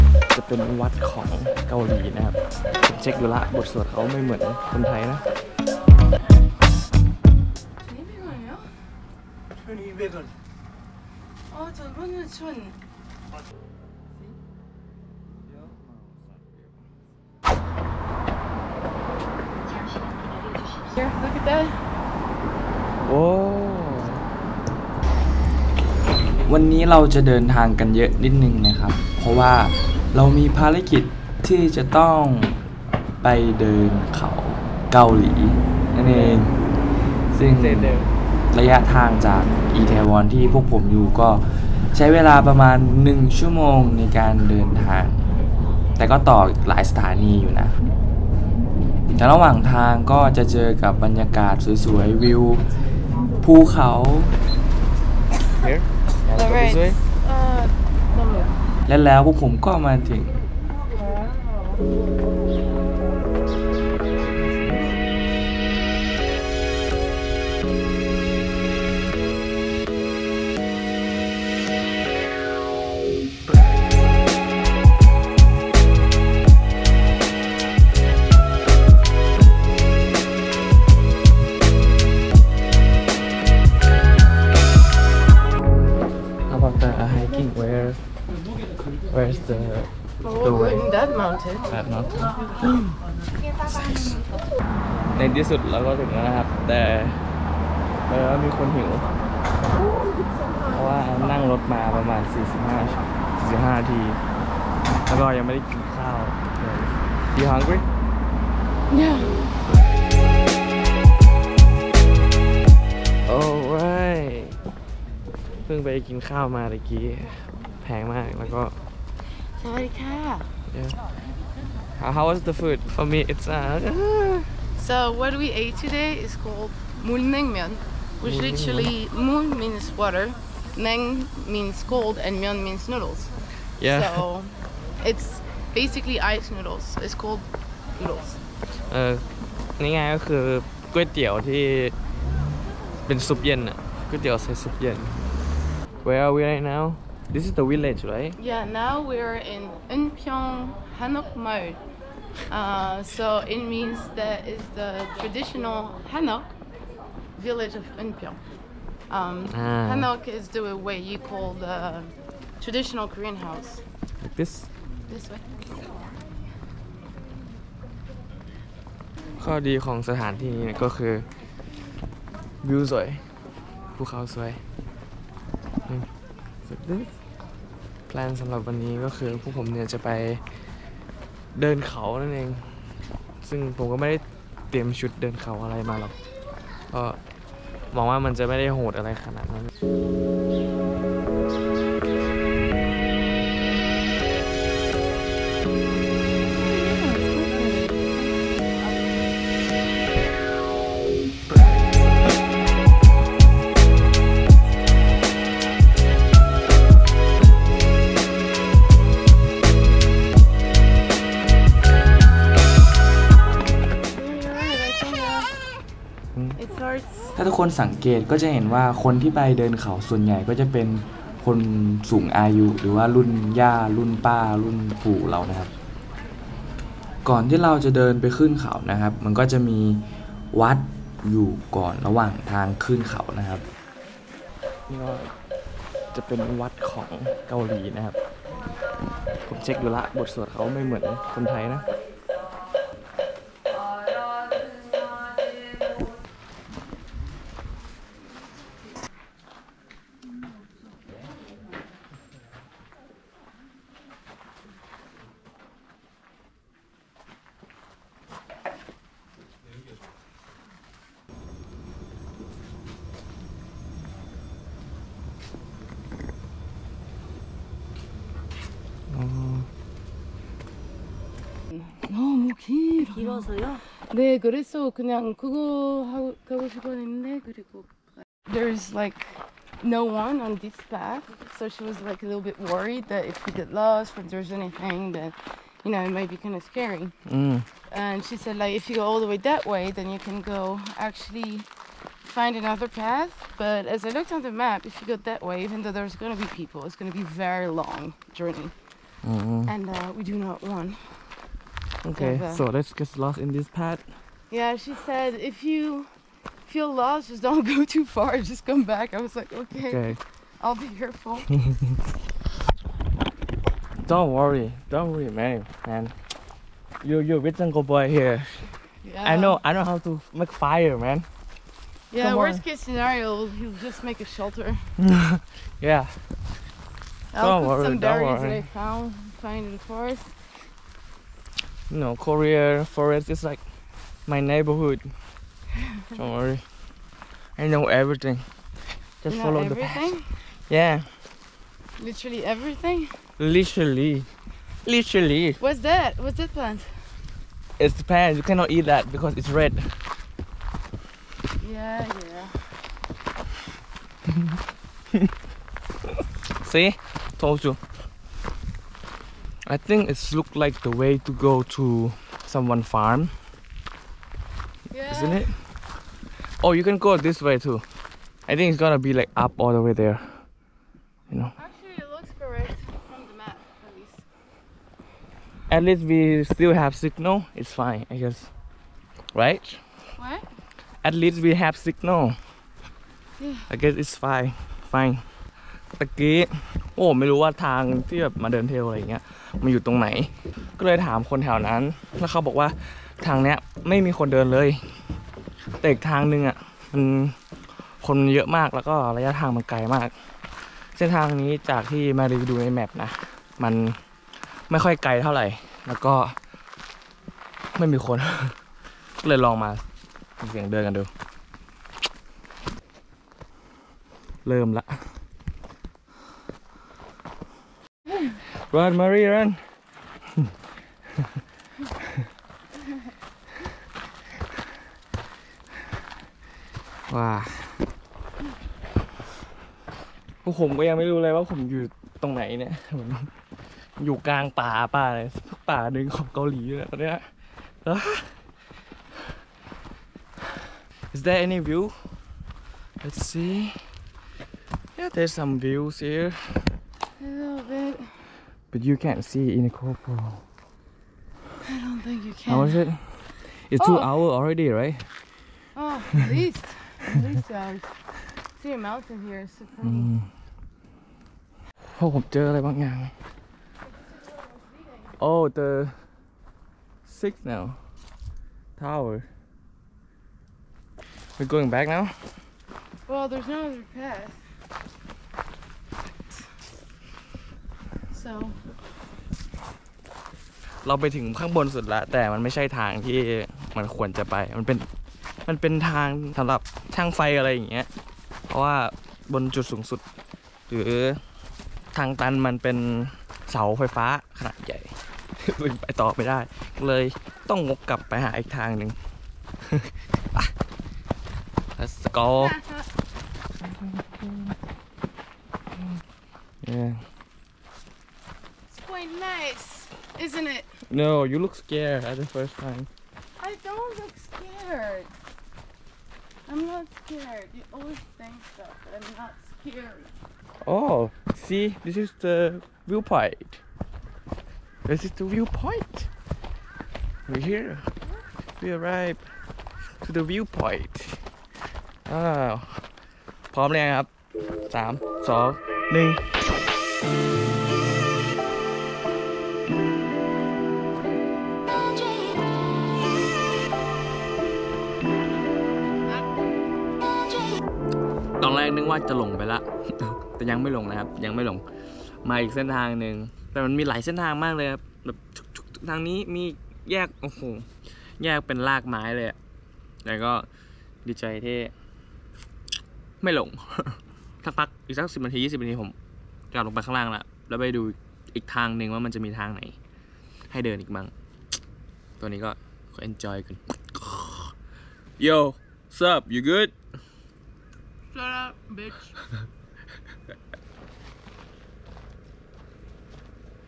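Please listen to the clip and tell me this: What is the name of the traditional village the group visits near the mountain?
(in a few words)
Unpyeong Hanok.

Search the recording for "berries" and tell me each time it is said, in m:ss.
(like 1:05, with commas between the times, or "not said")
5:27.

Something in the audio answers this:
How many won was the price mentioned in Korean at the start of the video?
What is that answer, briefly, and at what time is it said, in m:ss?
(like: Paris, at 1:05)
1200, at 0:12.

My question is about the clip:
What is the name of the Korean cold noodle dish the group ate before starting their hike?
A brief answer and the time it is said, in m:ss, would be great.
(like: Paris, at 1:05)
mulnengmyeon, at 2:07.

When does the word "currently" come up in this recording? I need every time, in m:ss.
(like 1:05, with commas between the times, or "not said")
not said.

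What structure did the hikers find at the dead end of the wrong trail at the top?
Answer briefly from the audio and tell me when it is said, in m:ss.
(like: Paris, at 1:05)
signal tower, at 7:45.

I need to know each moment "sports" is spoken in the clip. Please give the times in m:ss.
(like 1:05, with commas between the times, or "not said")
not said.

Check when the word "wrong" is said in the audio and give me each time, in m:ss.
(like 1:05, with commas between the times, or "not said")
not said.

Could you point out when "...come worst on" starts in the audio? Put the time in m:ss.
5:22.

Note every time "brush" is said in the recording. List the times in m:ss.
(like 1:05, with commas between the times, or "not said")
not said.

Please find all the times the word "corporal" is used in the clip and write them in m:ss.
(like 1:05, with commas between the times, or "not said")
7:29.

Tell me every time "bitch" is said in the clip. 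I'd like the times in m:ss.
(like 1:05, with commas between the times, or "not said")
9:38.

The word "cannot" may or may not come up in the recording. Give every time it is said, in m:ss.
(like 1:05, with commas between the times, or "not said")
5:48.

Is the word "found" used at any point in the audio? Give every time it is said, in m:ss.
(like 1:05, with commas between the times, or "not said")
5:28.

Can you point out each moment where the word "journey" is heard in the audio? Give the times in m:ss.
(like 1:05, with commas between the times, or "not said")
4:58.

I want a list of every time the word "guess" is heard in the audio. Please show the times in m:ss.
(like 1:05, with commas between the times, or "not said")
6:18, 6:23.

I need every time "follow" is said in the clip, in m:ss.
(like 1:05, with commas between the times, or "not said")
5:39.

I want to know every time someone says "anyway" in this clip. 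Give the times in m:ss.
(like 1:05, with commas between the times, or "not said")
not said.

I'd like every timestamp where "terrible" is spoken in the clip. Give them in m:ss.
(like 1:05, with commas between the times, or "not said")
not said.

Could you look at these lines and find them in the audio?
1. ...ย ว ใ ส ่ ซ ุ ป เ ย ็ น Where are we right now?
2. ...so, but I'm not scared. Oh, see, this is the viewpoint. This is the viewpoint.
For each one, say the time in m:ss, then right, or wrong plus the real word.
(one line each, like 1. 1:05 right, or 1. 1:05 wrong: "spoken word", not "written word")
1. 2:24 right
2. 8:38 right.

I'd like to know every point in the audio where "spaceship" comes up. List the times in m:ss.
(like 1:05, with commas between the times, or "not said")
not said.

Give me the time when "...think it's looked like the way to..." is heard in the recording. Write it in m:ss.
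5:59.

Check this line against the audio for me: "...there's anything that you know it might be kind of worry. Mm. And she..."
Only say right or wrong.
wrong.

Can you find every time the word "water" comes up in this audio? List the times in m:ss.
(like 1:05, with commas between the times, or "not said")
2:09.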